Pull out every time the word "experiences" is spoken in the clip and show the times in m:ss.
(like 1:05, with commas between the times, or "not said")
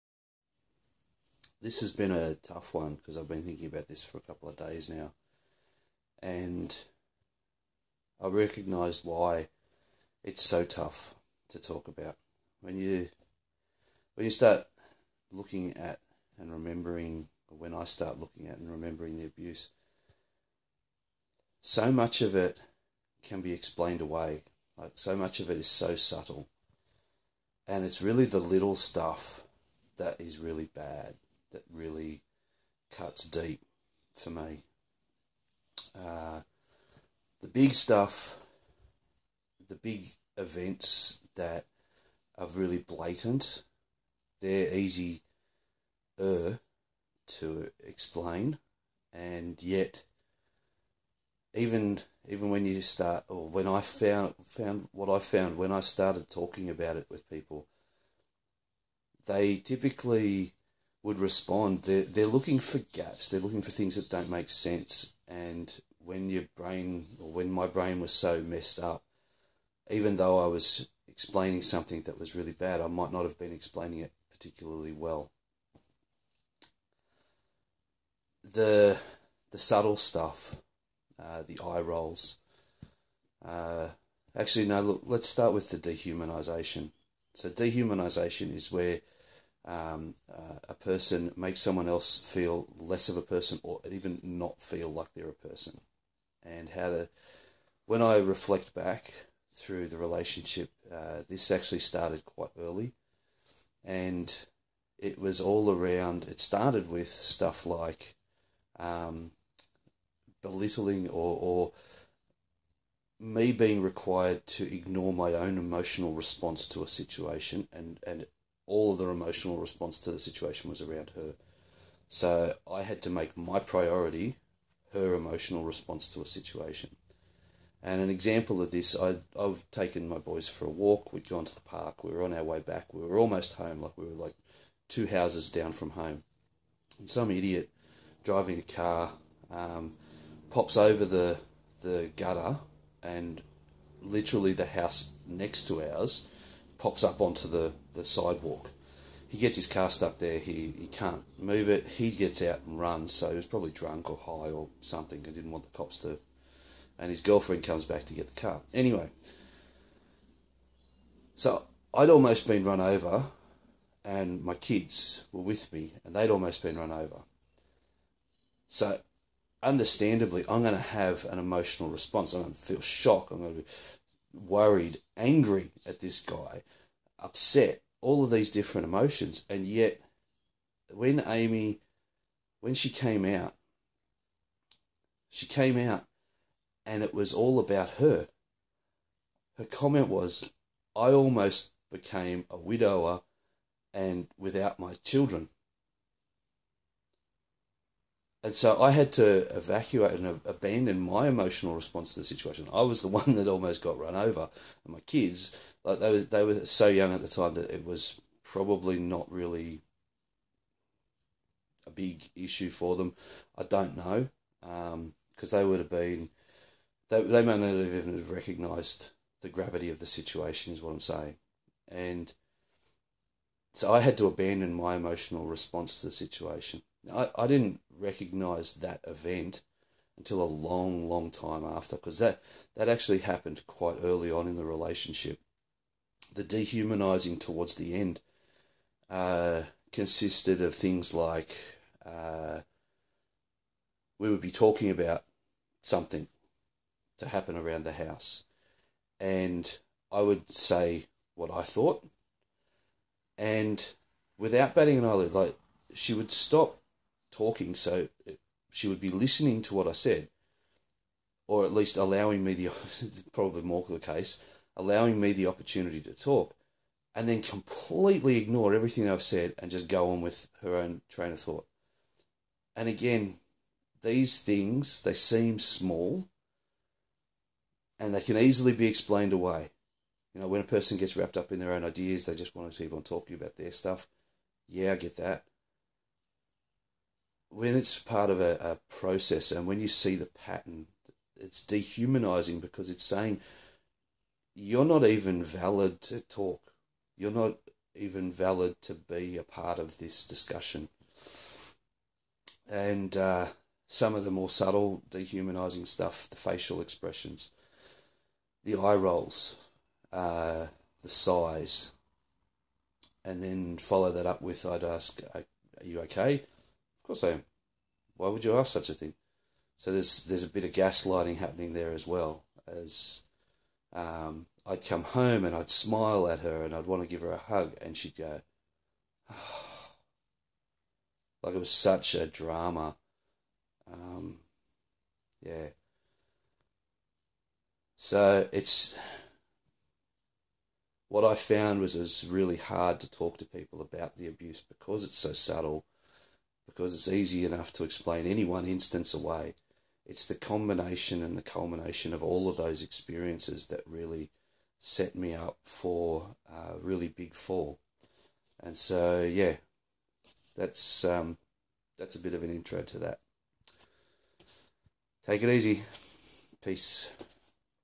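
5:52.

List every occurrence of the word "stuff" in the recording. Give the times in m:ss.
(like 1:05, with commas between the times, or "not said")
0:28, 0:37, 1:19, 1:47, 4:43, 5:05.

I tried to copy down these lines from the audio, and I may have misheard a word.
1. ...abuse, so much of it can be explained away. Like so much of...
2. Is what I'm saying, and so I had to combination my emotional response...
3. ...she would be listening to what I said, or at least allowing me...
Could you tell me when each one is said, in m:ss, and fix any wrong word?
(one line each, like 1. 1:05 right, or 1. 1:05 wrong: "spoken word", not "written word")
1. 0:19 right
2. 3:40 wrong: "abandon", not "combination"
3. 4:18 right.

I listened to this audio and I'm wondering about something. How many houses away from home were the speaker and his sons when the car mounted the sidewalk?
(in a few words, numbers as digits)
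2.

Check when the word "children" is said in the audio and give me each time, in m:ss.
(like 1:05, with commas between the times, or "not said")
3:15.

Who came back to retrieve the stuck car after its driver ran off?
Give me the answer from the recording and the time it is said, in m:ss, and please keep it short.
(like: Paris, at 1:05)
His girlfriend, at 2:37.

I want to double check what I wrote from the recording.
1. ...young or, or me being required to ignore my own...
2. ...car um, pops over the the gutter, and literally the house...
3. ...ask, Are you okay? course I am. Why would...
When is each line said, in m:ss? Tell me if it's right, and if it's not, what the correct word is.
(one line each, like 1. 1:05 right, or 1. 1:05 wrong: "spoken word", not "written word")
1. 1:50 wrong: "belittling", not "young"
2. 2:18 right
3. 5:14 right.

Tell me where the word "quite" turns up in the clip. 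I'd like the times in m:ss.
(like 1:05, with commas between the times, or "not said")
1:42, 3:53.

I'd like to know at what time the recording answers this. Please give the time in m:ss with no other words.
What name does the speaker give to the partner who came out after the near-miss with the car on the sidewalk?
3:01.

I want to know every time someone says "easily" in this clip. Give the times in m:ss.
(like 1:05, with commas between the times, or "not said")
4:38.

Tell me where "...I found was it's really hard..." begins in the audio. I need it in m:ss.
5:41.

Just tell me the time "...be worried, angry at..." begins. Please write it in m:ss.
2:53.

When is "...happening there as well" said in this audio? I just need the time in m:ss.
5:21.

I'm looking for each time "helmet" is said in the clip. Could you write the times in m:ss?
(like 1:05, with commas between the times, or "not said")
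not said.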